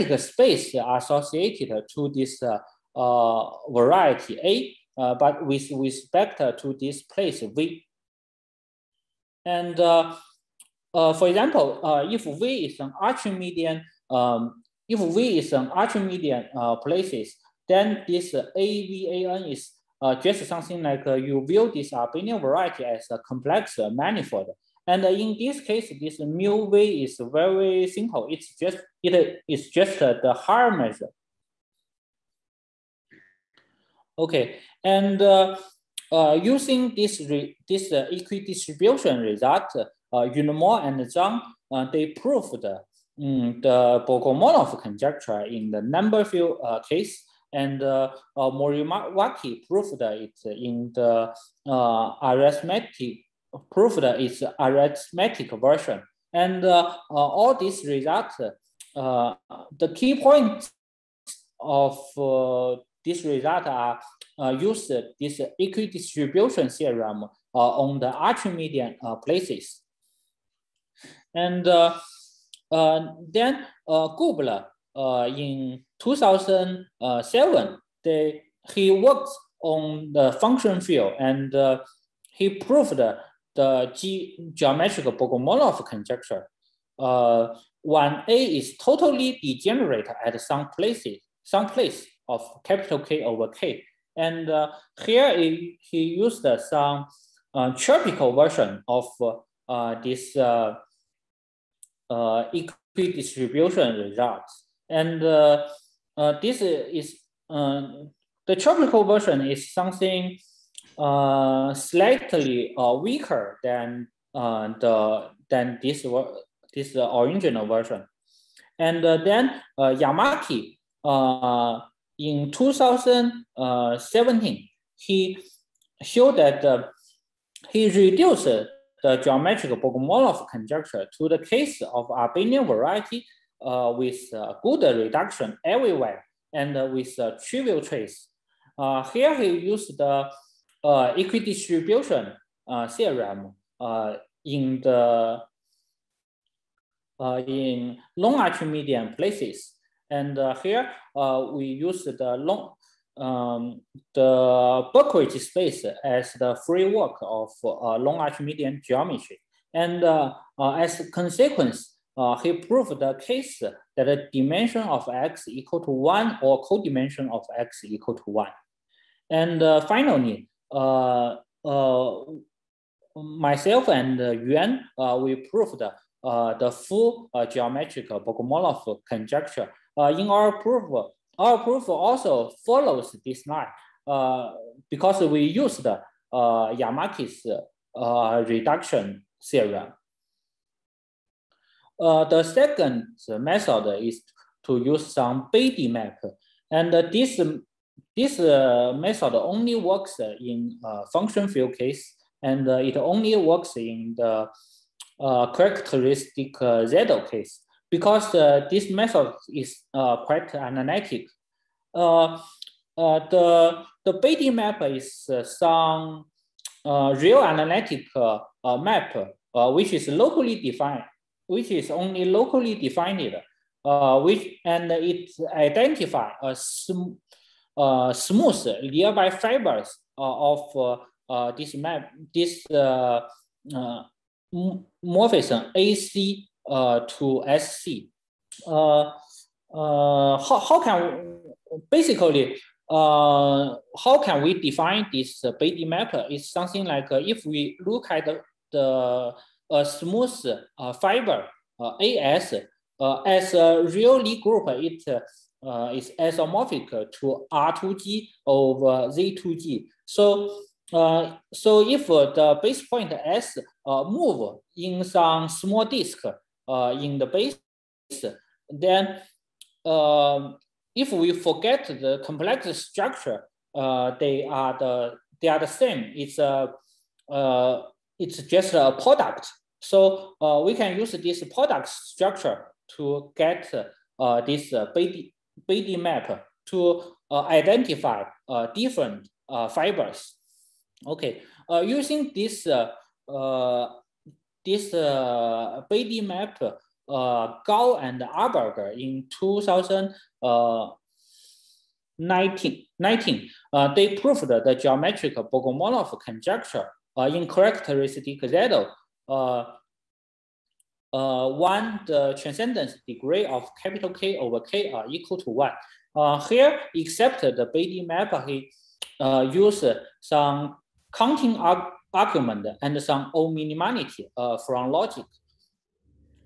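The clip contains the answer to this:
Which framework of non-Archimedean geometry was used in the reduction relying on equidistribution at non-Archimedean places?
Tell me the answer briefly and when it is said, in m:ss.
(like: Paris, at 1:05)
Berkovich space, at 2:34.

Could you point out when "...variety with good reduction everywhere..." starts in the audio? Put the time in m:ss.
2:12.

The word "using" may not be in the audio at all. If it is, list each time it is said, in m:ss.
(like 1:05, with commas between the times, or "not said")
0:36, 4:51.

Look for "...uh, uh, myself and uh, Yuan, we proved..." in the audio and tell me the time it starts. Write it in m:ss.
2:50.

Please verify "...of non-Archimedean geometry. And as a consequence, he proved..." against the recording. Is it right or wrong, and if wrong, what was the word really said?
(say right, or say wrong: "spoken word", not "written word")
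right.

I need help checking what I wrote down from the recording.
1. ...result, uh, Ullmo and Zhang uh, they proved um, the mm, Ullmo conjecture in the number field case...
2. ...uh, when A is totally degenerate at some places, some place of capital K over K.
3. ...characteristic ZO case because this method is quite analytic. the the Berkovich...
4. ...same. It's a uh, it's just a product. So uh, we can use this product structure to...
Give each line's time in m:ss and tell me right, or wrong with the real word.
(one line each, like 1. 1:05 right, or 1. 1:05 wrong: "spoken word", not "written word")
1. 0:39 wrong: "Bogomolov", not "Ullmo"
2. 1:26 right
3. 3:25 wrong: "Betti", not "Berkovich"
4. 4:35 right.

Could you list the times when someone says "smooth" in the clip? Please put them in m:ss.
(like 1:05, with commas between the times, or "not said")
3:48, 4:09.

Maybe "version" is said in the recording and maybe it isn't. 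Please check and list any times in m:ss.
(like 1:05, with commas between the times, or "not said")
0:55, 1:38, 1:49, 1:57.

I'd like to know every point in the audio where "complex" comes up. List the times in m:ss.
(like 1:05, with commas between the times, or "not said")
0:23, 4:32.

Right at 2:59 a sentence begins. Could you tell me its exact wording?
in our proof, our proof also follows this line because we used Yamaki's reduction theorem.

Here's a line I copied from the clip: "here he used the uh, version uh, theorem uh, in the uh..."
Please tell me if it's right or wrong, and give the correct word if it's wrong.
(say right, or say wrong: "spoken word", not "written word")
wrong: "equidistribution", not "version".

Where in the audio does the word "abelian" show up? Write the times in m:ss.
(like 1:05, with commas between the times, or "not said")
0:21, 2:12.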